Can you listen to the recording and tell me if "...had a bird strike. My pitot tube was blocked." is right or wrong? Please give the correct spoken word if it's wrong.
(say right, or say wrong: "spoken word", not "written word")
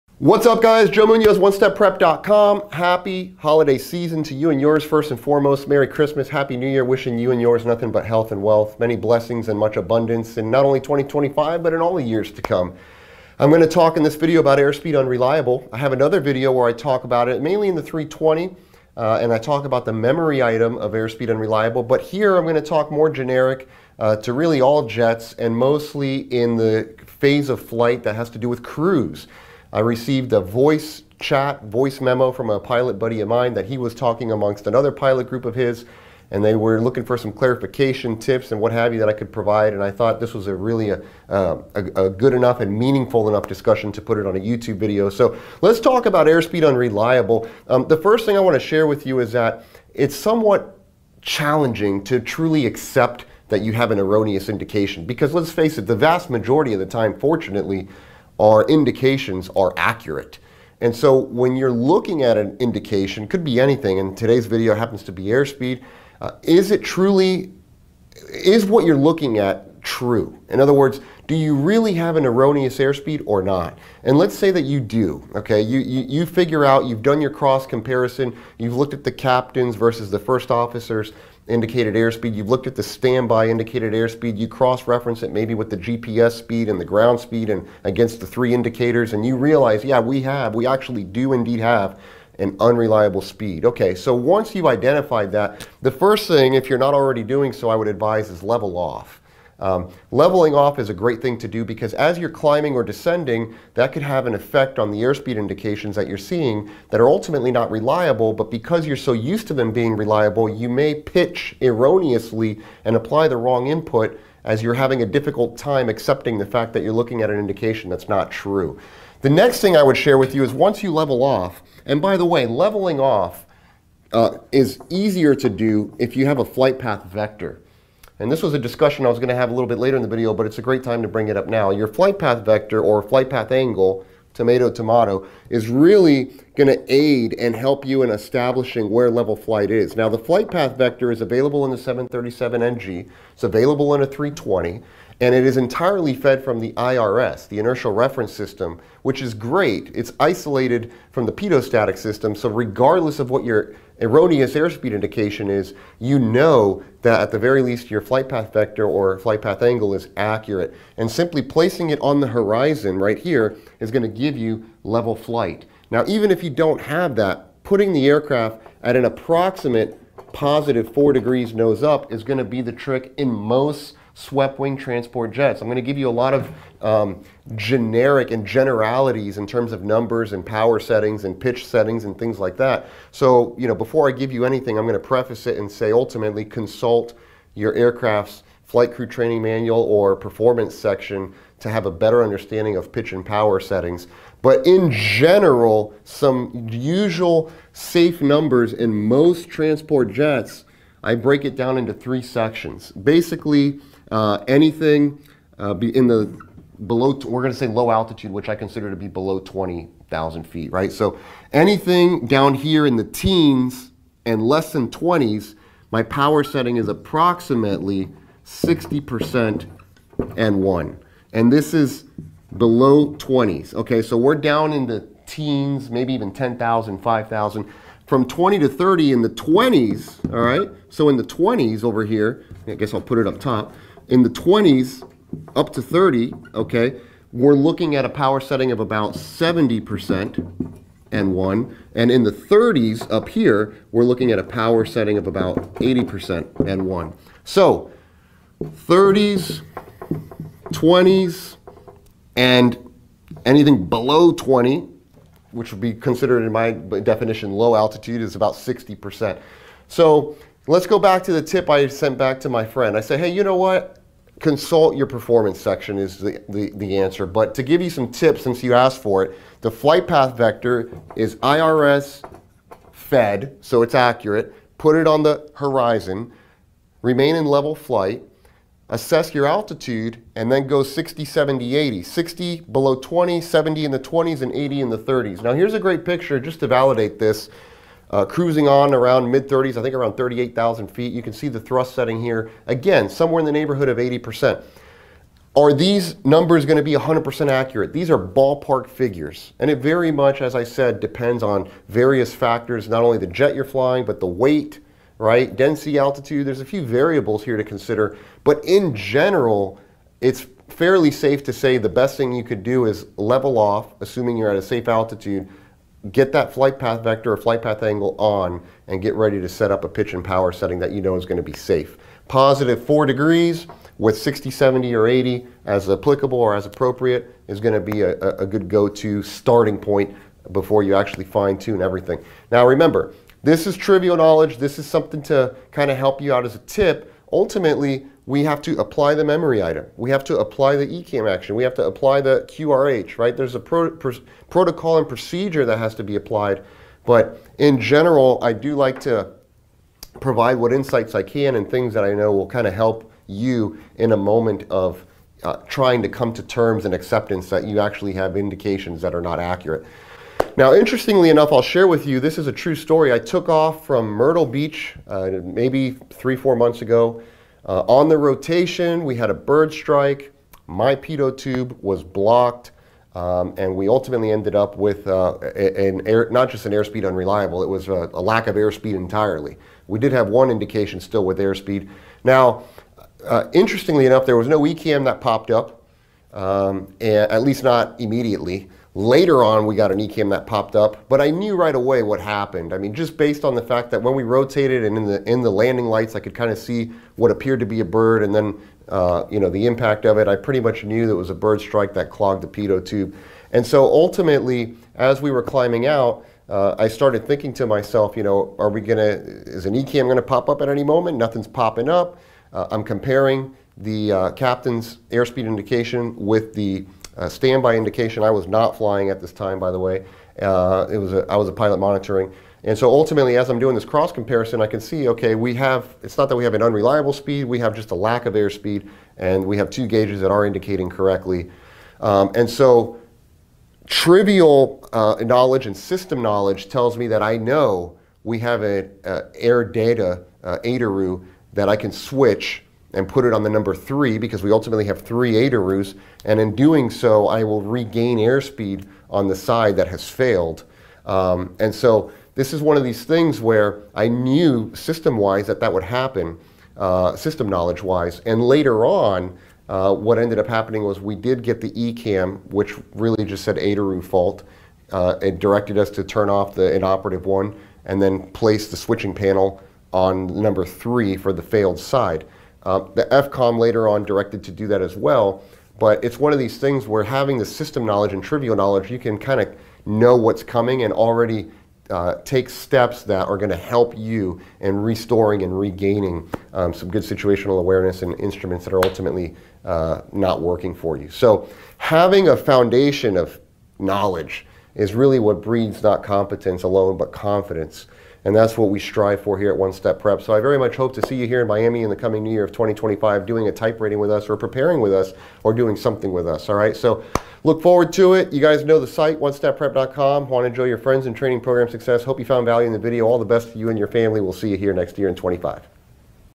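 right.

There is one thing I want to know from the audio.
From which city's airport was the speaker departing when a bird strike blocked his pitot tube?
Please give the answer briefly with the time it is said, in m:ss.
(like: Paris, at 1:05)
Myrtle Beach, at 6:04.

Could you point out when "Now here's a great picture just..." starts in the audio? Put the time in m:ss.
4:45.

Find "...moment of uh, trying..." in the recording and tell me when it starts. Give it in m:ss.
5:54.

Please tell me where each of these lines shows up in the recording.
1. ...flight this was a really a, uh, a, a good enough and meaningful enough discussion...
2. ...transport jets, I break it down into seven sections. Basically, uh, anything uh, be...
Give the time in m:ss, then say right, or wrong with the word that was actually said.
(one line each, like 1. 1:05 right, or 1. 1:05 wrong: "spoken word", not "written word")
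1. 0:39 wrong: "thought", not "flight"
2. 3:19 wrong: "three", not "seven".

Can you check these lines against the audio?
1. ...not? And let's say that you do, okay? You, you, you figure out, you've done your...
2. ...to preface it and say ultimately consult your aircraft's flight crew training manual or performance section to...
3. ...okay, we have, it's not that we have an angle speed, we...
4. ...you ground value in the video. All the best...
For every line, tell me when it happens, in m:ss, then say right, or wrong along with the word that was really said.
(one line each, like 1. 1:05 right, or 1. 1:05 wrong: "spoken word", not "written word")
1. 1:13 right
2. 3:04 right
3. 7:05 wrong: "unreliable", not "angle"
4. 8:32 wrong: "found", not "ground".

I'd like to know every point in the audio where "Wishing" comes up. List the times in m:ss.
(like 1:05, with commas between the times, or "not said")
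0:06.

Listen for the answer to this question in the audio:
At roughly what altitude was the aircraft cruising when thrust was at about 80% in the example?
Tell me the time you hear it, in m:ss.
4:50.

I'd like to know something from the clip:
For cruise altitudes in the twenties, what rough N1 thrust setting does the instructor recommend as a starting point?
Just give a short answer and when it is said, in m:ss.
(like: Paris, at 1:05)
70%, at 3:59.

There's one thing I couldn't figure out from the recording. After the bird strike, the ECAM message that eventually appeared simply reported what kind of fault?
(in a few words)
ADIRU fault.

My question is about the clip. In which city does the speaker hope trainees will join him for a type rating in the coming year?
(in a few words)
Miami.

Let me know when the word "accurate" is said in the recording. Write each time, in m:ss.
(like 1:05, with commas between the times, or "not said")
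0:59, 2:40, 4:33, 4:57, 5:59.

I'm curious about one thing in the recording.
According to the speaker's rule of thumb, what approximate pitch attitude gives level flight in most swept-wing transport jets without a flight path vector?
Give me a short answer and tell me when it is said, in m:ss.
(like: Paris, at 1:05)
4 degrees nose up, at 2:50.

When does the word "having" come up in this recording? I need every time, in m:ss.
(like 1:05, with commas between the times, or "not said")
1:54, 7:57, 8:11.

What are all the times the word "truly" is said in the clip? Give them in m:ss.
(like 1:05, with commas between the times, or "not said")
0:52, 1:06.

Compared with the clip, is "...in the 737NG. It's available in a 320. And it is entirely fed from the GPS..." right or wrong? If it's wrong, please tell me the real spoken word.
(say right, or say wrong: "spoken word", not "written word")
wrong: "IRS", not "GPS".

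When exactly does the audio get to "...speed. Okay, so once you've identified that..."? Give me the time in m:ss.
1:33.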